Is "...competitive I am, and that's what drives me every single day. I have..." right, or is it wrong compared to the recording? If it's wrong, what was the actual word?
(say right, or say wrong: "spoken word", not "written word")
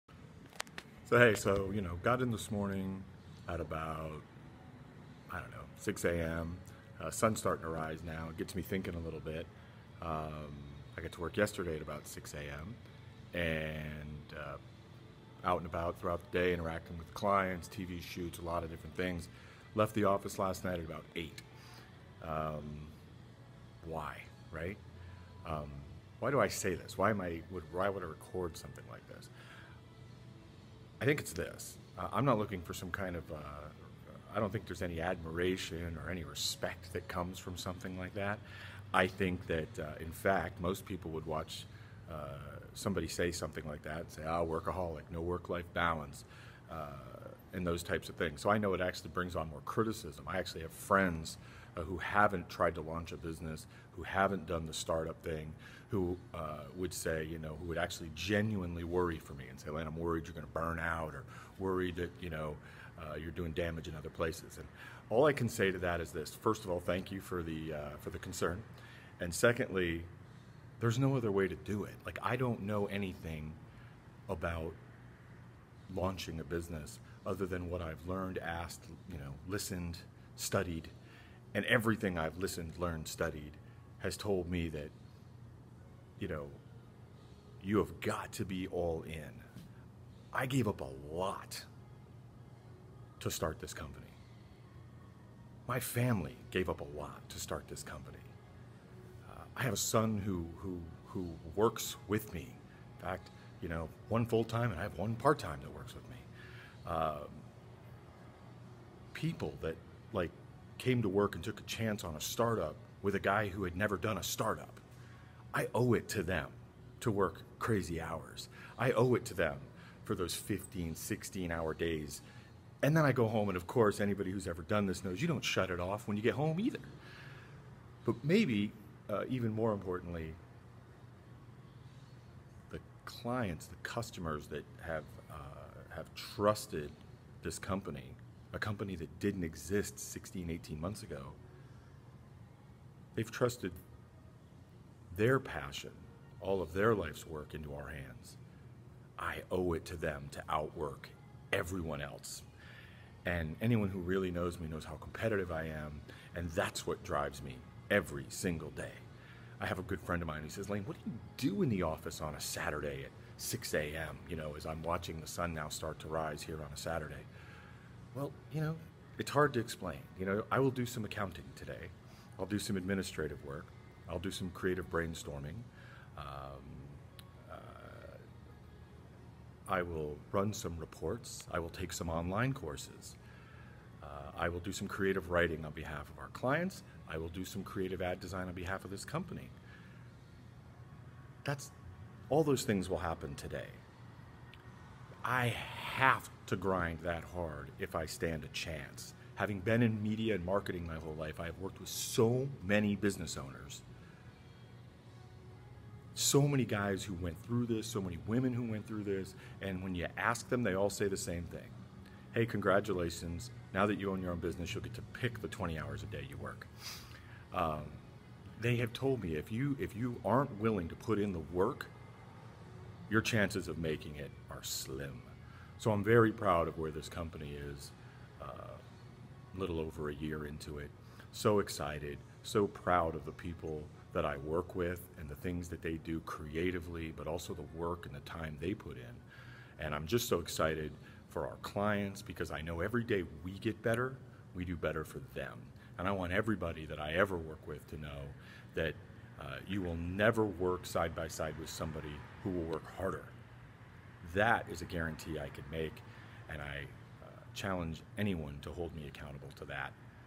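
right.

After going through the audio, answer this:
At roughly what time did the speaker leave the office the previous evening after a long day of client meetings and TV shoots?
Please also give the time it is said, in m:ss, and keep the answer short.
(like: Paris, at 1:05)
8, at 0:20.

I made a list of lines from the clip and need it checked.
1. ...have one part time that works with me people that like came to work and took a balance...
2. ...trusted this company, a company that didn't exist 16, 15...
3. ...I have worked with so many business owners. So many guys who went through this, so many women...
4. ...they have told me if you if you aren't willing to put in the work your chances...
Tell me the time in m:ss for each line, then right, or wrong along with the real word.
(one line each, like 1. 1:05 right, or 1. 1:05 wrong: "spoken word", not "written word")
1. 1:44 wrong: "chance", not "balance"
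2. 2:16 wrong: "18", not "15"
3. 3:21 right
4. 3:38 right.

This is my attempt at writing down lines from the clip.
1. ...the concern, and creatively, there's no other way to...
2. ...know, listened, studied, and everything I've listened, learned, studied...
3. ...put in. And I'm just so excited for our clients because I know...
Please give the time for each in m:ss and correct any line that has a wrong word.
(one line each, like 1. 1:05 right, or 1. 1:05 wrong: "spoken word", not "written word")
1. 1:08 wrong: "secondly", not "creatively"
2. 1:19 right
3. 3:58 right.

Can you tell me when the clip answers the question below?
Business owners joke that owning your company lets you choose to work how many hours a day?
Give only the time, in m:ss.
3:35.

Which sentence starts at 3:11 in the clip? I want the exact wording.
That's all those things will happen today.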